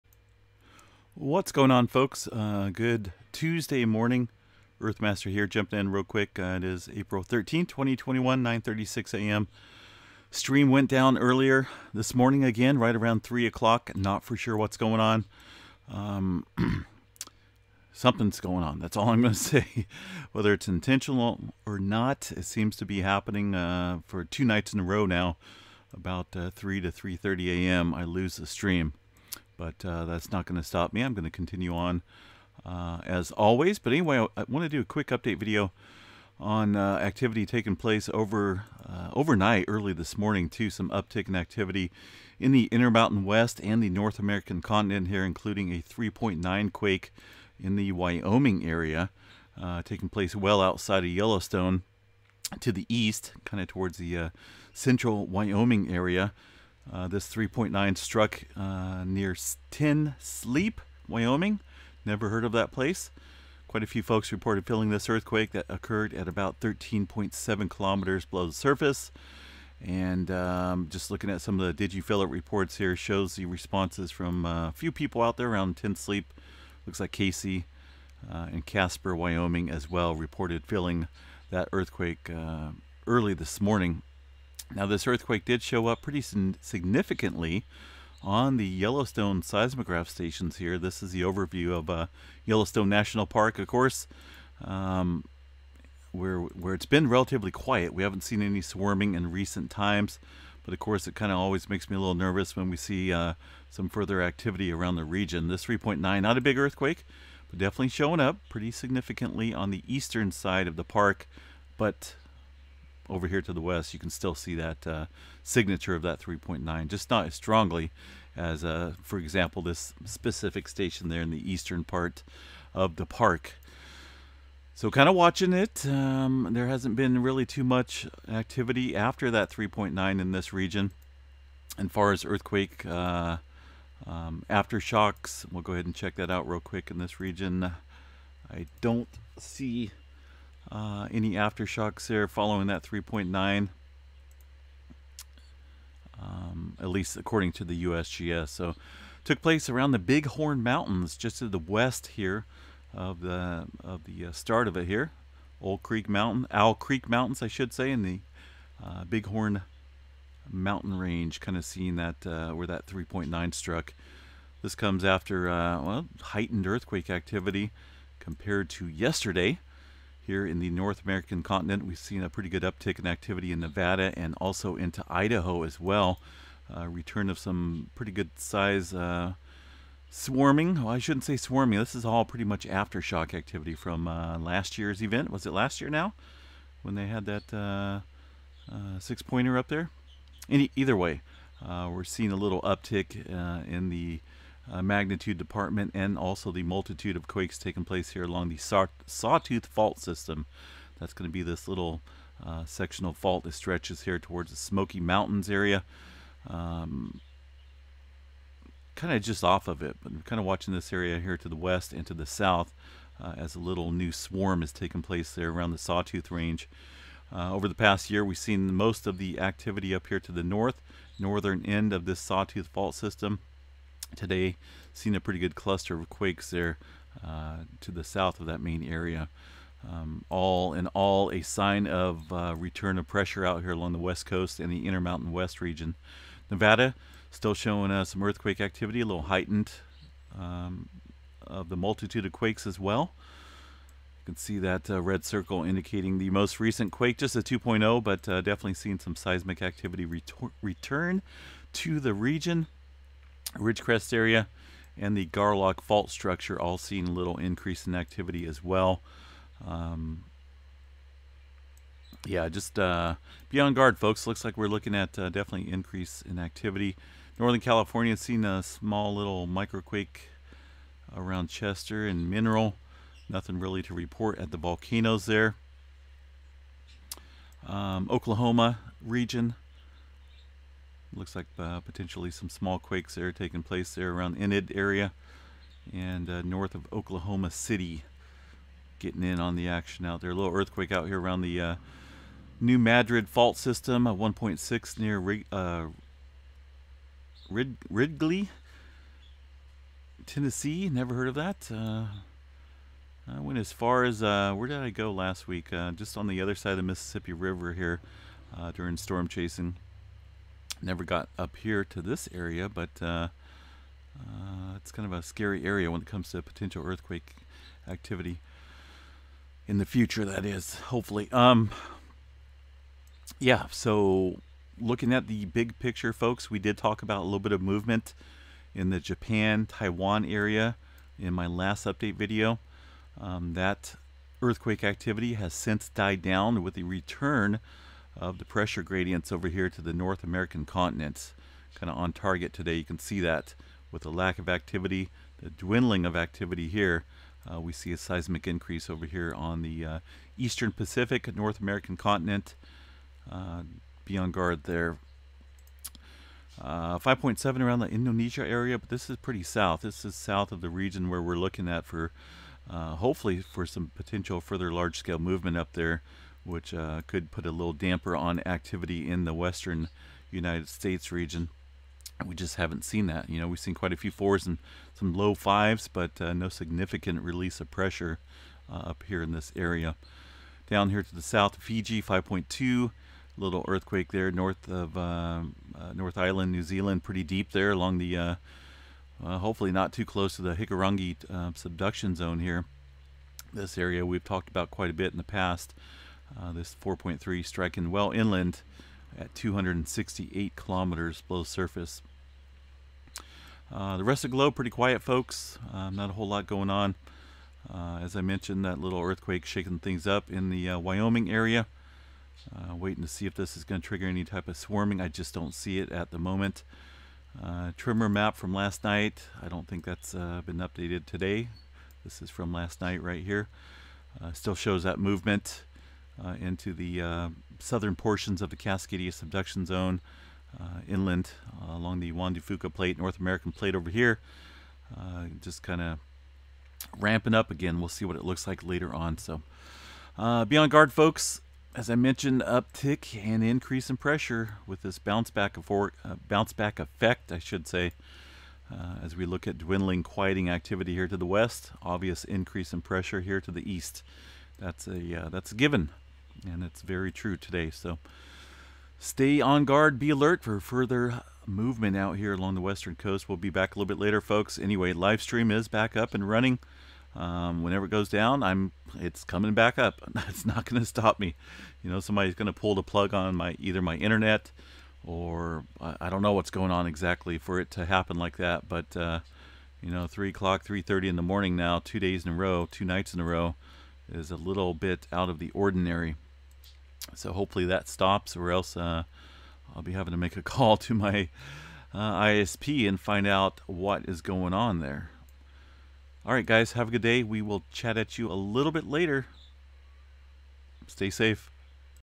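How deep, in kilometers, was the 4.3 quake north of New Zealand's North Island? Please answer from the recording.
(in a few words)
268 kilometers.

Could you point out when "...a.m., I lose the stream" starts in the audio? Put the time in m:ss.
0:27.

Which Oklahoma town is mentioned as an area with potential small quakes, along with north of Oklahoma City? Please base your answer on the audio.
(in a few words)
Enid.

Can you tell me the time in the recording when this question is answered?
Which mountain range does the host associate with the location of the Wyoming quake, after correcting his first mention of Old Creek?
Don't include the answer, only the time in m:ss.
2:36.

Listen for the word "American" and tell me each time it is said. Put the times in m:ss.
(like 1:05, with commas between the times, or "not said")
0:44, 2:51, 5:40, 5:51, 7:13.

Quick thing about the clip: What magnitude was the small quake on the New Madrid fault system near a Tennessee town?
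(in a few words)
1.6.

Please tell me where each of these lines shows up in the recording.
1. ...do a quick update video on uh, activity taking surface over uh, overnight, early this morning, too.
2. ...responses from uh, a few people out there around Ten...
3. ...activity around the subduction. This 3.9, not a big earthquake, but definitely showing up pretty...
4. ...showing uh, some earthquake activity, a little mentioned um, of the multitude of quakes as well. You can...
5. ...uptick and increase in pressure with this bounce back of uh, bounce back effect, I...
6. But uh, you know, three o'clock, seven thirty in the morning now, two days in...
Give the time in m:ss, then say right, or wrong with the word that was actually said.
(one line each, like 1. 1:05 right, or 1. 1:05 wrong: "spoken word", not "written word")
1. 0:34 wrong: "place", not "surface"
2. 1:13 right
3. 1:44 wrong: "region", not "subduction"
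4. 3:57 wrong: "heightened", not "mentioned"
5. 7:22 right
6. 7:58 wrong: "three", not "seven".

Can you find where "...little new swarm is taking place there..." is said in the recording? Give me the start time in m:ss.
3:33.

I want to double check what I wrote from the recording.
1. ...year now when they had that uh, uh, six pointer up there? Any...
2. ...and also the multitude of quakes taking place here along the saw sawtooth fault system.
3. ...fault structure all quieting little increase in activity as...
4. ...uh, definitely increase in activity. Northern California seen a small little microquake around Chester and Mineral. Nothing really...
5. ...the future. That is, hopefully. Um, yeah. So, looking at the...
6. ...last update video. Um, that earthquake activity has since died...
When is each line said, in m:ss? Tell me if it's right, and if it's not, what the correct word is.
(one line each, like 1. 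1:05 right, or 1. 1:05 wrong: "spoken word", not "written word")
1. 3:05 right
2. 3:15 right
3. 4:15 wrong: "seeing", not "quieting"
4. 4:25 right
5. 5:19 right
6. 5:31 right.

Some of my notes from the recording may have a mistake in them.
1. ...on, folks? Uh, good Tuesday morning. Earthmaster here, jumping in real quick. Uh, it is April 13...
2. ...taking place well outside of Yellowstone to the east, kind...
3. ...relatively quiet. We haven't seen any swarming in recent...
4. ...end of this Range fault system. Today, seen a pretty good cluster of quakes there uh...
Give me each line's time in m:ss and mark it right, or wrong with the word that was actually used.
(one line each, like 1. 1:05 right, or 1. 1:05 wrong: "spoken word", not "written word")
1. 0:01 right
2. 0:49 right
3. 1:37 right
4. 3:41 wrong: "Sawtooth", not "Range".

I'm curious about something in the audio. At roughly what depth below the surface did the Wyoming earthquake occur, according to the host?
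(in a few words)
13.7 kilometers.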